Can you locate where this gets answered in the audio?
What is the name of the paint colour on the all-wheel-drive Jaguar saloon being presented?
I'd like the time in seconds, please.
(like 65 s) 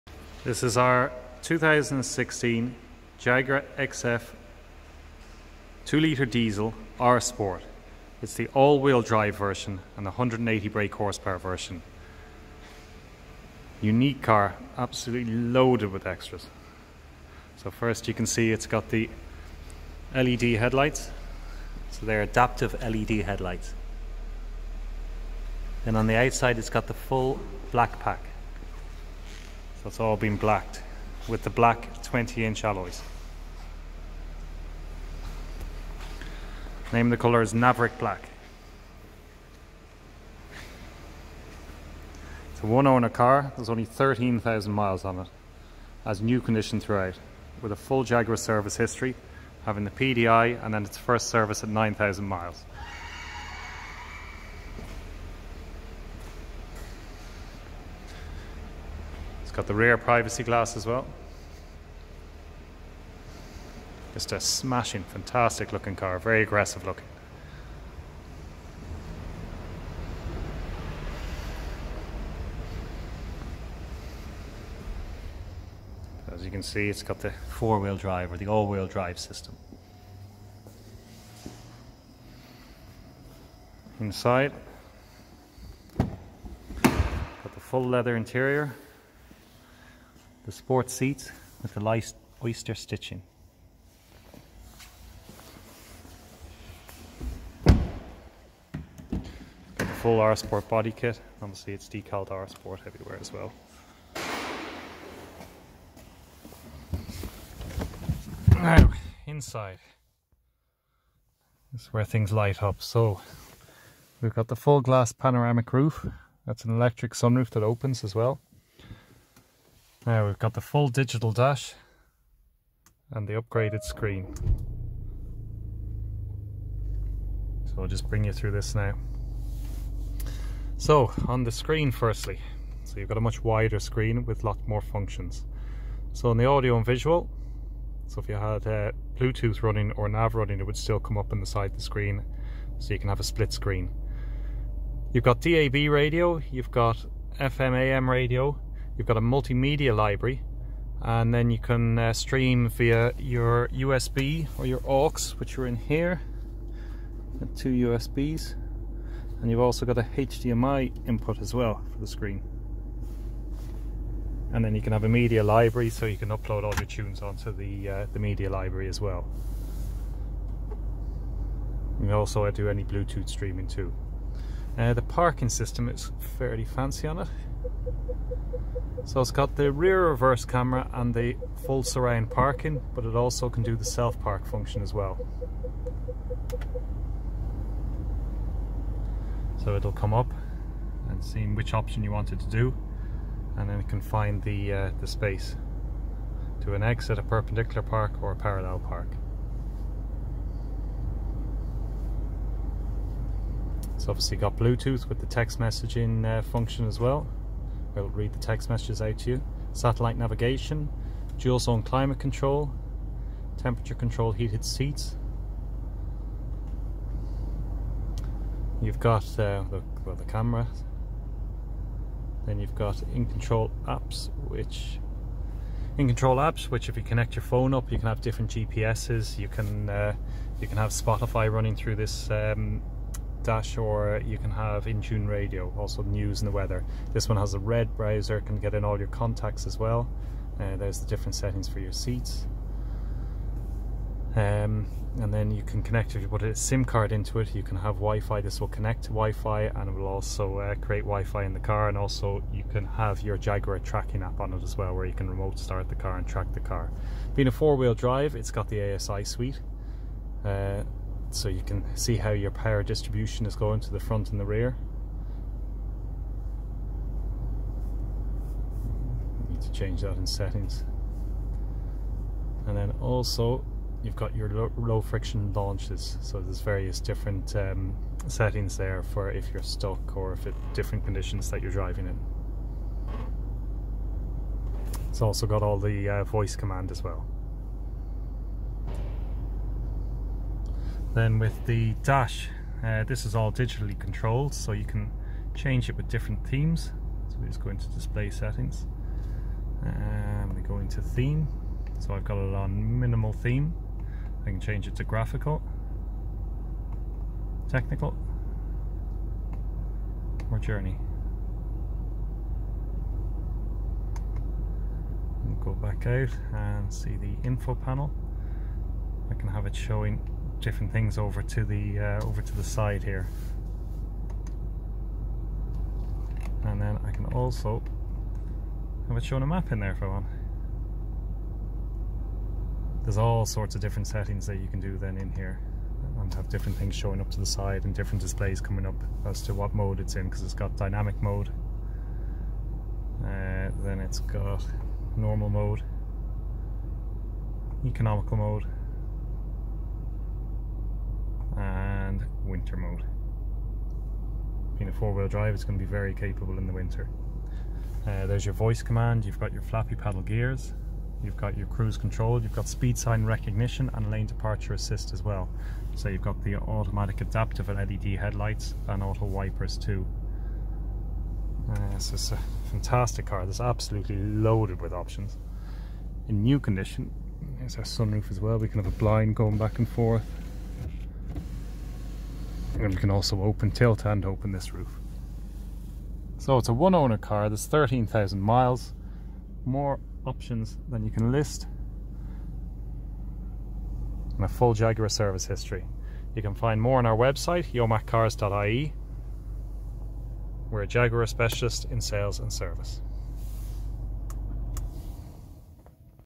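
37 s.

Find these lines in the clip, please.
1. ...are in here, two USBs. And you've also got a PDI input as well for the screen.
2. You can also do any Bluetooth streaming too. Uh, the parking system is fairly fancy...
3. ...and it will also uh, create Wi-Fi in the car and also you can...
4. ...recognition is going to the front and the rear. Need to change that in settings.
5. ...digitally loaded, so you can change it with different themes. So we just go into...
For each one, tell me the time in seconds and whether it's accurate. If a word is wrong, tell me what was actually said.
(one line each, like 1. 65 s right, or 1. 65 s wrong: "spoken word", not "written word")
1. 155 s wrong: "HDMI", not "PDI"
2. 171 s right
3. 249 s right
4. 262 s wrong: "distribution", not "recognition"
5. 293 s wrong: "controlled", not "loaded".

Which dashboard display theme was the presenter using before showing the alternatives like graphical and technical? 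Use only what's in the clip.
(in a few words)
minimal.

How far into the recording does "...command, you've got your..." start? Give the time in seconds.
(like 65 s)
358 s.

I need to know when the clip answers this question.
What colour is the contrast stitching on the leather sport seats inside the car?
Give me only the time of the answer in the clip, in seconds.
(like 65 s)
91 s.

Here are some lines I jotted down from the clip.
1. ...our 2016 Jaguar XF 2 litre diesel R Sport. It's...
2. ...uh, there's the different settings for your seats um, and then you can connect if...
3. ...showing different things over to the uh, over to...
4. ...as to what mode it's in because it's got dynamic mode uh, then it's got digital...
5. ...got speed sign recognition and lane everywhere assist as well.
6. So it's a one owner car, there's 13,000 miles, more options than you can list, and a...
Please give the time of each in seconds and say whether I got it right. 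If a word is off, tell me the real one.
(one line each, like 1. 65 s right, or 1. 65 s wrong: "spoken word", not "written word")
1. 0 s right
2. 240 s right
3. 319 s right
4. 339 s wrong: "normal", not "digital"
5. 362 s wrong: "departure", not "everywhere"
6. 386 s right.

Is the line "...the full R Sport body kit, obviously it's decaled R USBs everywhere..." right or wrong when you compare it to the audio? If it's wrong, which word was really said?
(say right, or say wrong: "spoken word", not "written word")
wrong: "Sport", not "USBs".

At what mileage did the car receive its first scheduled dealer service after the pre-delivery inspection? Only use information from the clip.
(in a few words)
9,000 miles.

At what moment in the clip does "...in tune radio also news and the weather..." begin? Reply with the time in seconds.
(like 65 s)
234 s.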